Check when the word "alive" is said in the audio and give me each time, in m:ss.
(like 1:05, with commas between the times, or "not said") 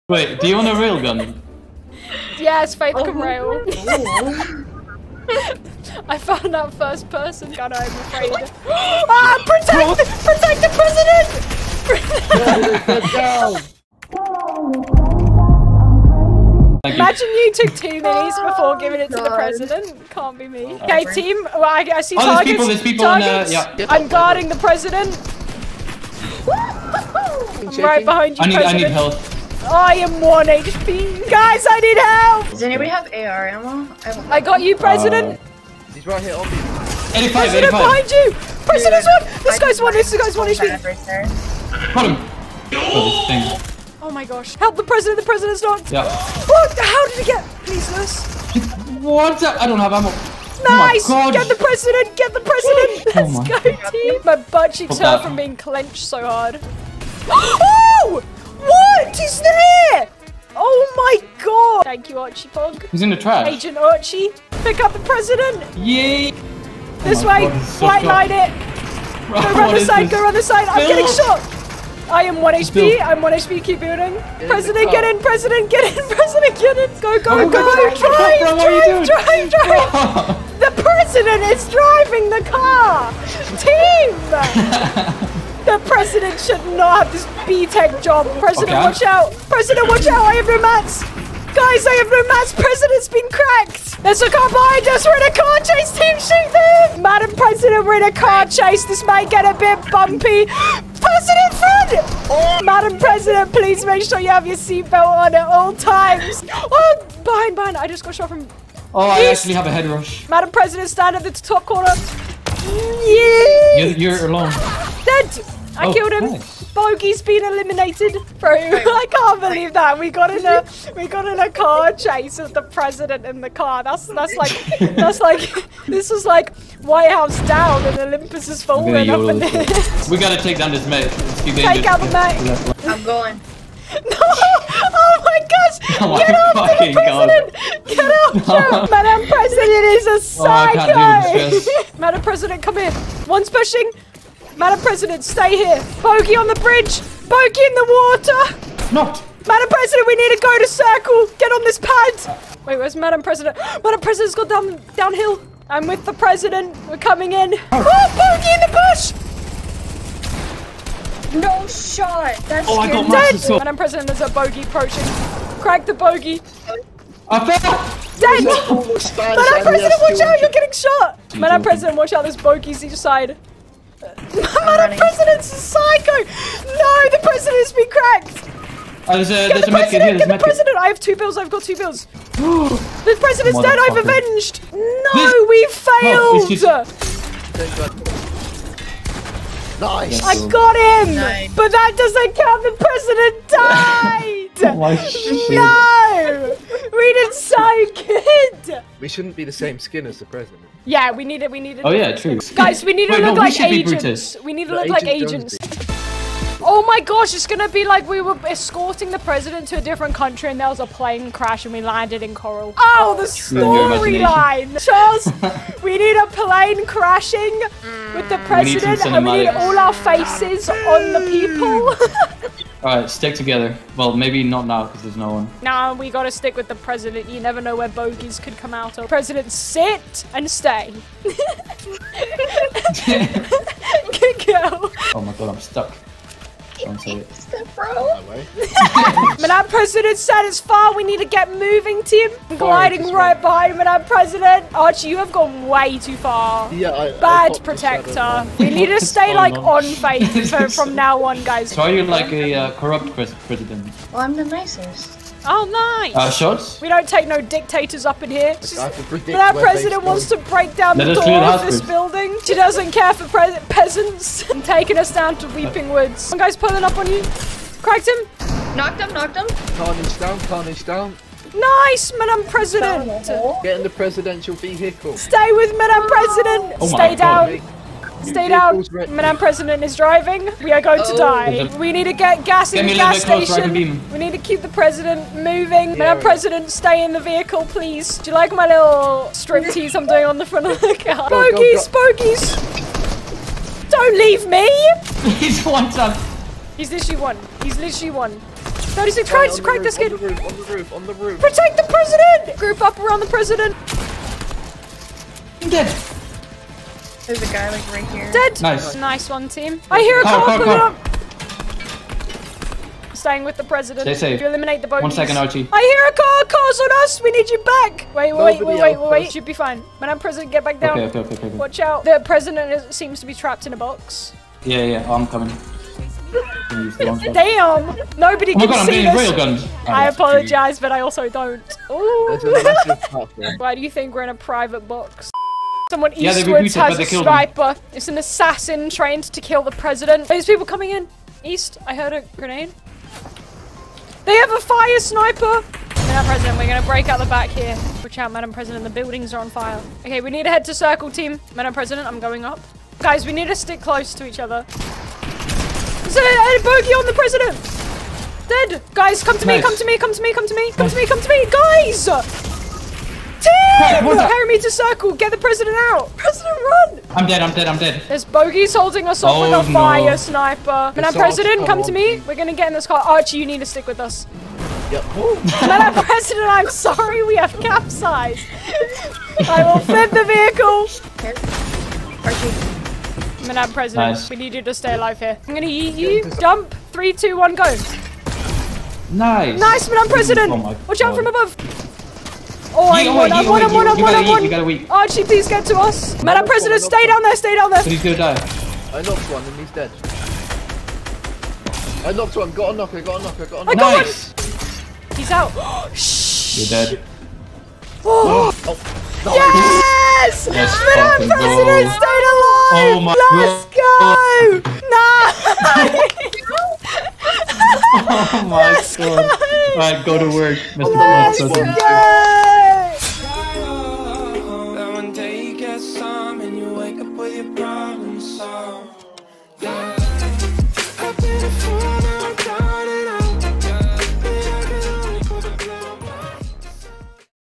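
6:24, 6:52.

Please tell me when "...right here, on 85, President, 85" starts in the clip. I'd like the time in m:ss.
0:36.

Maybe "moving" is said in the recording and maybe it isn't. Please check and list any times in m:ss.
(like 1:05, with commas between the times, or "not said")
4:01, 4:45.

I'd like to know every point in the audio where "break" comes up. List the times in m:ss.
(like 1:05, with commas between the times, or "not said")
4:20, 5:46.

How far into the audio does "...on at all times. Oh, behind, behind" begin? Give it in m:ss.
1:45.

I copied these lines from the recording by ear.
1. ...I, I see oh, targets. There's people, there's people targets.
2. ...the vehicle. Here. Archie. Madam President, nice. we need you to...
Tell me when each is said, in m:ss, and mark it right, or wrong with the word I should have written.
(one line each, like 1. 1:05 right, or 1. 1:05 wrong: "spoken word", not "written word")
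1. 0:21 right
2. 6:20 right.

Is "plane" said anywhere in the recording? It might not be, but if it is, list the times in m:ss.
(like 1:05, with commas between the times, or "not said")
3:30, 3:36.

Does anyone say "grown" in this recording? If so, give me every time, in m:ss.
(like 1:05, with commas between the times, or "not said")
not said.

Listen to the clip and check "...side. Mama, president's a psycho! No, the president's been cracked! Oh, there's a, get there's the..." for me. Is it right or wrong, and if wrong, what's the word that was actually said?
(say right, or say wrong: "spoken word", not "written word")
right.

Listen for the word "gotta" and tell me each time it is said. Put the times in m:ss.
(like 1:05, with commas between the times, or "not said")
2:10, 3:46.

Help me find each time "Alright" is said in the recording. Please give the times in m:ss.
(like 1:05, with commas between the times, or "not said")
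3:42, 6:59.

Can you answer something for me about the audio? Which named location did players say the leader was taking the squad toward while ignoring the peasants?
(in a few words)
Weeping Woods.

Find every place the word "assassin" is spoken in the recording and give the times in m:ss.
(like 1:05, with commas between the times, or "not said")
5:38.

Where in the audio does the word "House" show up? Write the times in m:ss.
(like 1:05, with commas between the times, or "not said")
2:07.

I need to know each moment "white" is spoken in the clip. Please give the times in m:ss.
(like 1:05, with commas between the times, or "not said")
1:07, 2:06.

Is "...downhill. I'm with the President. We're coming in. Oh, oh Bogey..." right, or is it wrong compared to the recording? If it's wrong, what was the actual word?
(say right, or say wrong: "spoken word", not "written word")
right.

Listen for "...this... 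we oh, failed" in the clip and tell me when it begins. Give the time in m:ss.
3:05.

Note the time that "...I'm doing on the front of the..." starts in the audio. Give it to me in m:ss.
4:49.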